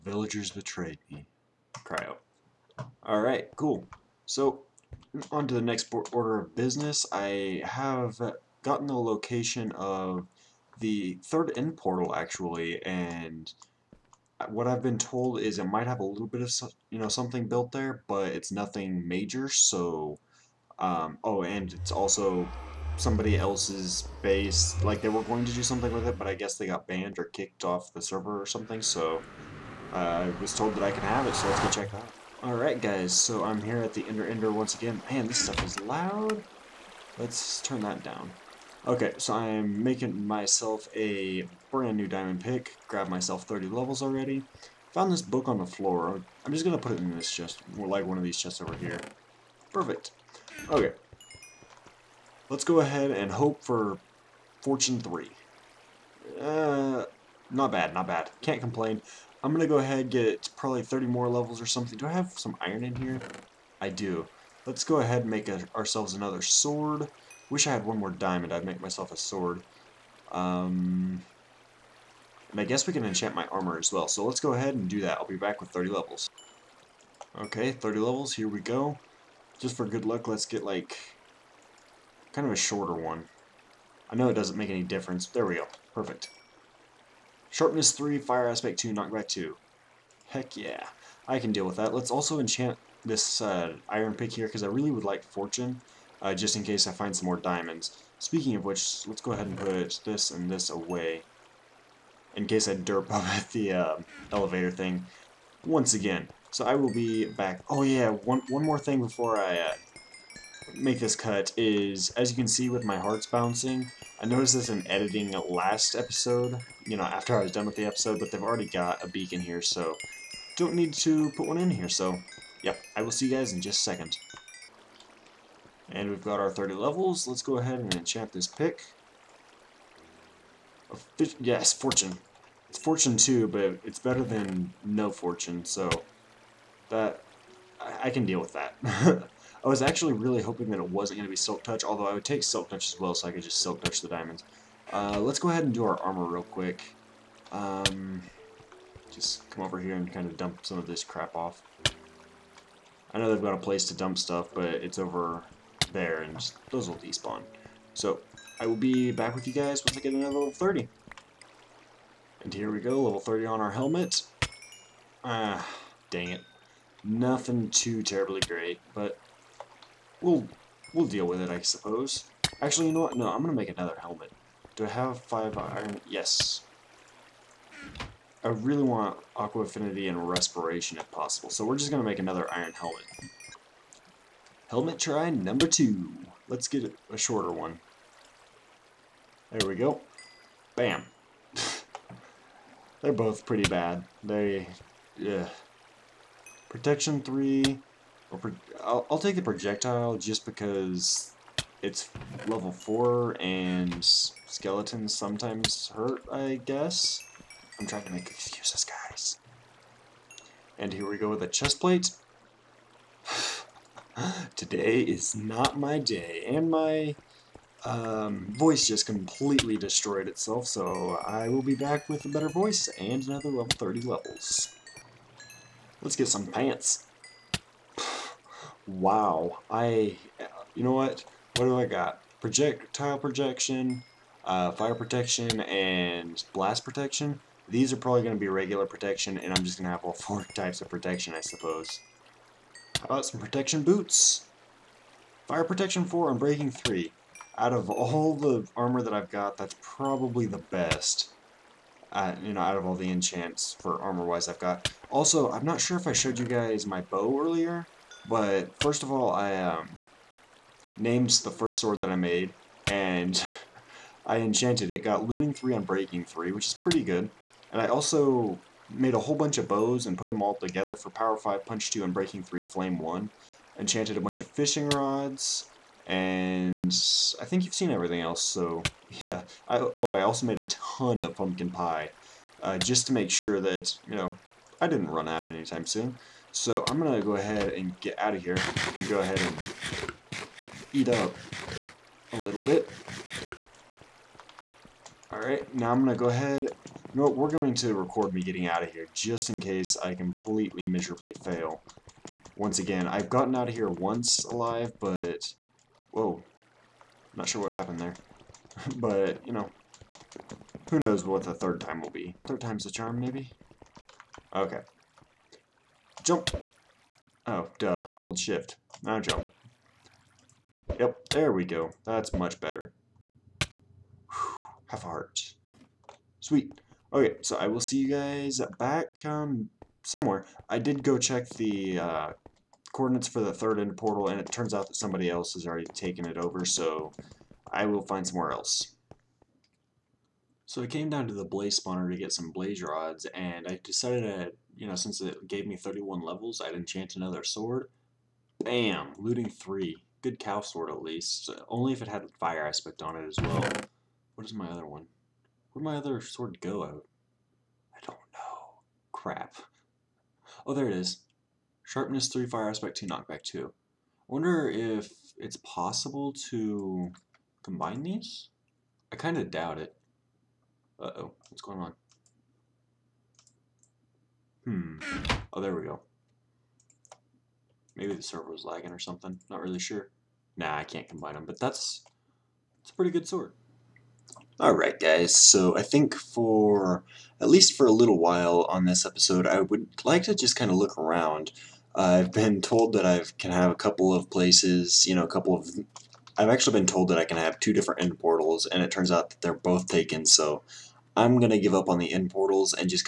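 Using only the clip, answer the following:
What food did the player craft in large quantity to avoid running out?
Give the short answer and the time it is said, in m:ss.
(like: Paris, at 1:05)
pumpkin pie, at 4:41.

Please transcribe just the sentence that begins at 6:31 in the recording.
Uh, I've been told that I can have a couple of places, you know, a couple of...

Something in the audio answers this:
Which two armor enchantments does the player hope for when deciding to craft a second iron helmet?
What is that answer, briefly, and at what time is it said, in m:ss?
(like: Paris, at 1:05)
Aqua Affinity and Respiration, at 2:59.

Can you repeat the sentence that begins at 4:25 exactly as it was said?
Got looting 3 unbreaking 3, which is pretty good.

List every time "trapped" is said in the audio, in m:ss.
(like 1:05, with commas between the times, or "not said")
not said.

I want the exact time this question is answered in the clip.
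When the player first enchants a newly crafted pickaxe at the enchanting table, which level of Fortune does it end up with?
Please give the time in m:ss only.
0:54.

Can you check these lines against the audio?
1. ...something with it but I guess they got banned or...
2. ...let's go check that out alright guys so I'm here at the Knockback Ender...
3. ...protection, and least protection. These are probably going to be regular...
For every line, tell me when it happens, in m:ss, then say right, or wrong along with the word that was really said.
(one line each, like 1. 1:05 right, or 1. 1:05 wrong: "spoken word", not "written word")
1. 0:25 right
2. 0:31 wrong: "Ender", not "Knockback"
3. 3:54 wrong: "blast", not "least".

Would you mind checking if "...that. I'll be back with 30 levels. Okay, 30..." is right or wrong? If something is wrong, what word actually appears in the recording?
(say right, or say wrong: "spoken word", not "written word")
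right.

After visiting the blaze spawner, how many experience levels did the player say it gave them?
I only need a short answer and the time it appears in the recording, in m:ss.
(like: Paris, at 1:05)
31, at 5:45.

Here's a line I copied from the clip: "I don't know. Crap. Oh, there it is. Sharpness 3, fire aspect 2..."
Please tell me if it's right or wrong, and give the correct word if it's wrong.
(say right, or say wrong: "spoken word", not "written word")
right.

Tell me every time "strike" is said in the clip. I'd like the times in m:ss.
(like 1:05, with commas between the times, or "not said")
not said.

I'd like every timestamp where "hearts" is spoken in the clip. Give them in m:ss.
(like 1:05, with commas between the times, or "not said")
1:52, 5:25.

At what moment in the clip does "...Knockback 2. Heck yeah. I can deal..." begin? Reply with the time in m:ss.
1:28.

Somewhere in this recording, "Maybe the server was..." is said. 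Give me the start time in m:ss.
6:17.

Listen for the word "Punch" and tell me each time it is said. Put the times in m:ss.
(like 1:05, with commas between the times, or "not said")
4:31.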